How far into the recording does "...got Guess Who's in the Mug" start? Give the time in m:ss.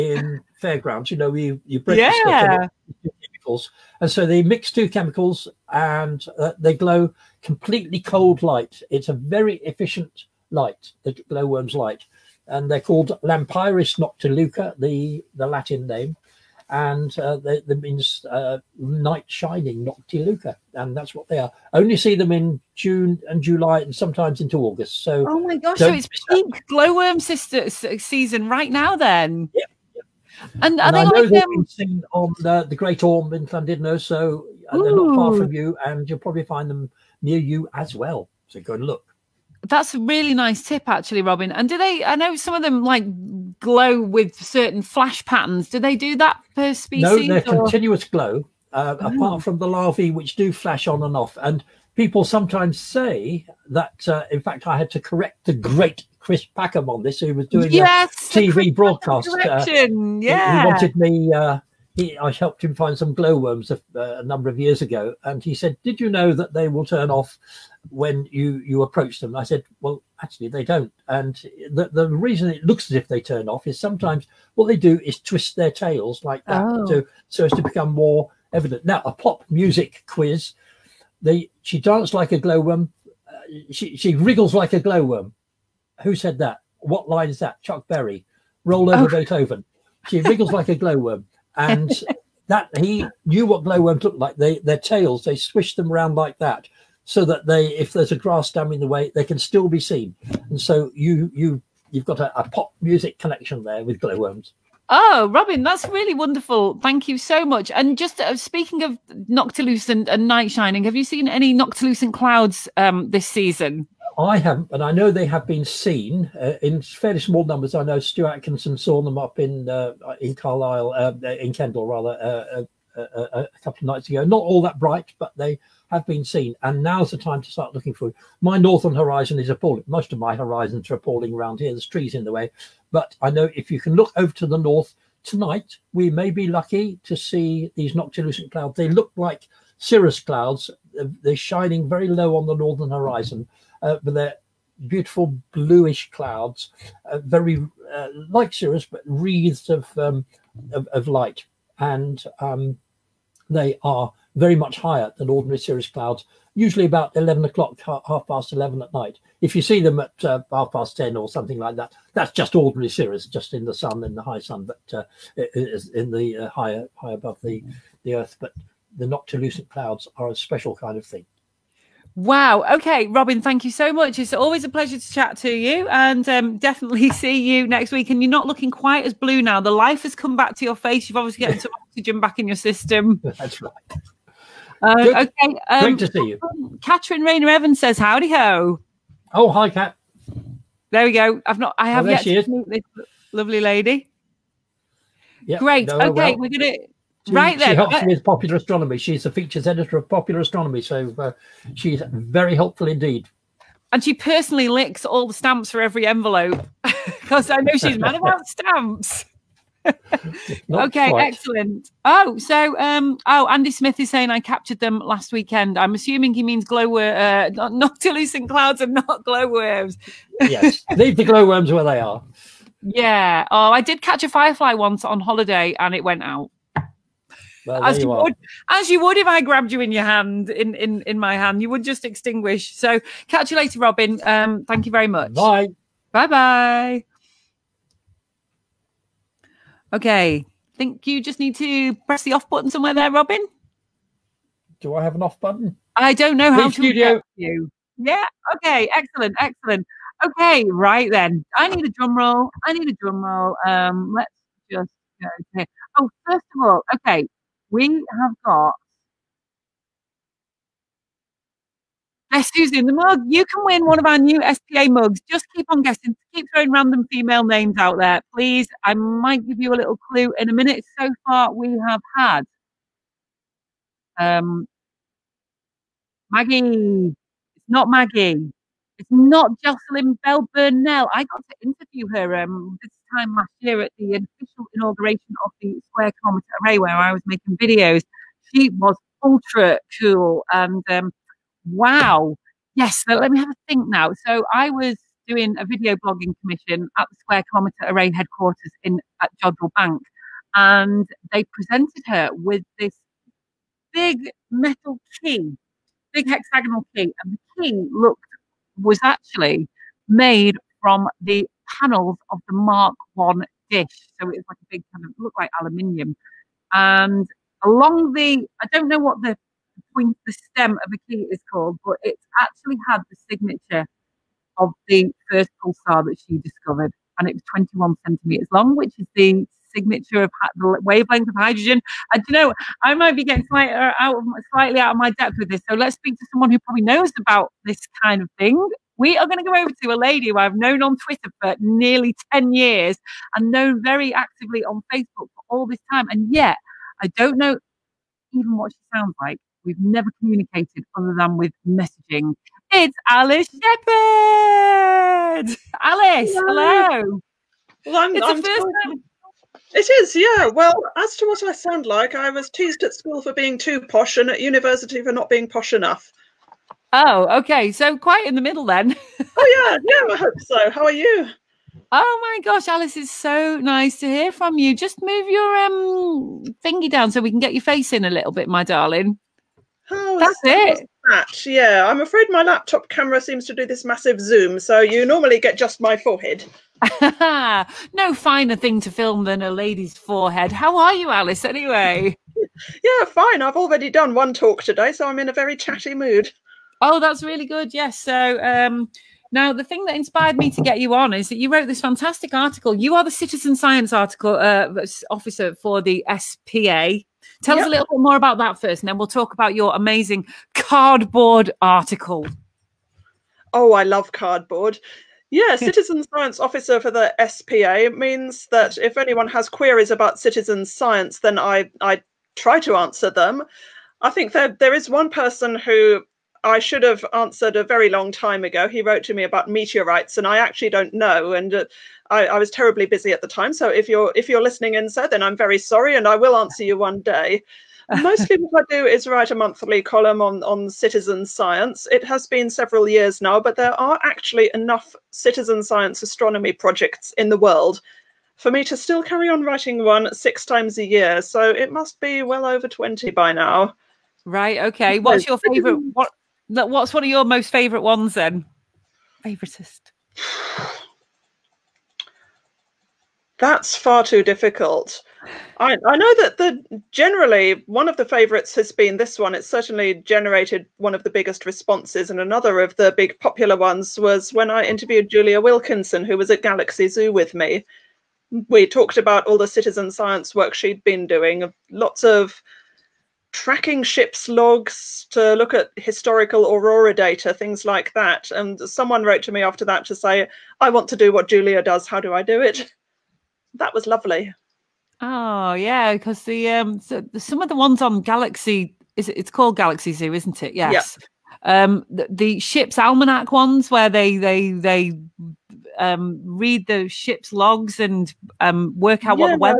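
4:18.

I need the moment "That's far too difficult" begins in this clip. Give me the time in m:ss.
7:43.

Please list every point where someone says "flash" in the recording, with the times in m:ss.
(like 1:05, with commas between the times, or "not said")
0:44, 0:50.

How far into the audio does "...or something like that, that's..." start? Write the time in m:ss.
2:41.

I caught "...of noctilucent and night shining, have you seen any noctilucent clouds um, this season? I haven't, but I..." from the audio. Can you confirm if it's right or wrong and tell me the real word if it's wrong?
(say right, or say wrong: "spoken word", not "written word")
right.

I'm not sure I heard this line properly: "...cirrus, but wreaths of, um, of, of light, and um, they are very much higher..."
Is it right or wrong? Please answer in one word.
right.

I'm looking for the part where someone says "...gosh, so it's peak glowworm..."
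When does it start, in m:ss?
0:25.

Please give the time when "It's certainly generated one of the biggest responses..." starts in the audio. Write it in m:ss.
7:49.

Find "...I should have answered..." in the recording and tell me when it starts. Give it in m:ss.
7:06.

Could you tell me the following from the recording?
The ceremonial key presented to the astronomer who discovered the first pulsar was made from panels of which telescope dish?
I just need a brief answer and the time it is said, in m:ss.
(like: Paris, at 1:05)
Mark One, at 5:12.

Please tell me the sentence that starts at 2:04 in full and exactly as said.
Not all that bright, but they have been seen.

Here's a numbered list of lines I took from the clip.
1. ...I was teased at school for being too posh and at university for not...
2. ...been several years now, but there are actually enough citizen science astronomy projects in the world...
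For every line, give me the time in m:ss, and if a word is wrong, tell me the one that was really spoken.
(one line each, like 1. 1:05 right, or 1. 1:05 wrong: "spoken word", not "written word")
1. 6:02 right
2. 7:22 right.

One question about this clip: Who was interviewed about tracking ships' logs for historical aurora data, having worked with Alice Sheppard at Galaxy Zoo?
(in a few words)
Julia Wilkinson.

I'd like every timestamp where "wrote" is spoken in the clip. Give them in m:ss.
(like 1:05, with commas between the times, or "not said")
6:41, 7:08, 8:09.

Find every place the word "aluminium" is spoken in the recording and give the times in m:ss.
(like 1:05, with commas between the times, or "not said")
5:15.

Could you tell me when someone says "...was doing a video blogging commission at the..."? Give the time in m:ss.
4:54.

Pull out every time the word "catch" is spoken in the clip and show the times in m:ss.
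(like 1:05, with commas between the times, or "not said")
3:44, 3:53.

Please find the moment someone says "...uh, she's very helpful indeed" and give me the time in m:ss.
3:21.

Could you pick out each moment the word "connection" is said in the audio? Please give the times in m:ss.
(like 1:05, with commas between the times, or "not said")
1:43.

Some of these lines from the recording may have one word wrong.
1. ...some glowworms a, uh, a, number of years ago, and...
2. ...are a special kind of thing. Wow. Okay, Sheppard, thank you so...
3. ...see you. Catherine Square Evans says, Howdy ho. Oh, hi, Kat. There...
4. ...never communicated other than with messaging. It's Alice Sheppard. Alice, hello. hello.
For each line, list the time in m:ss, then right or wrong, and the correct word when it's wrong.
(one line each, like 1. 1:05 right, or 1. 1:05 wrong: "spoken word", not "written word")
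1. 1:02 right
2. 2:50 wrong: "Robin", not "Sheppard"
3. 3:06 wrong: "Rayner", not "Square"
4. 5:49 right.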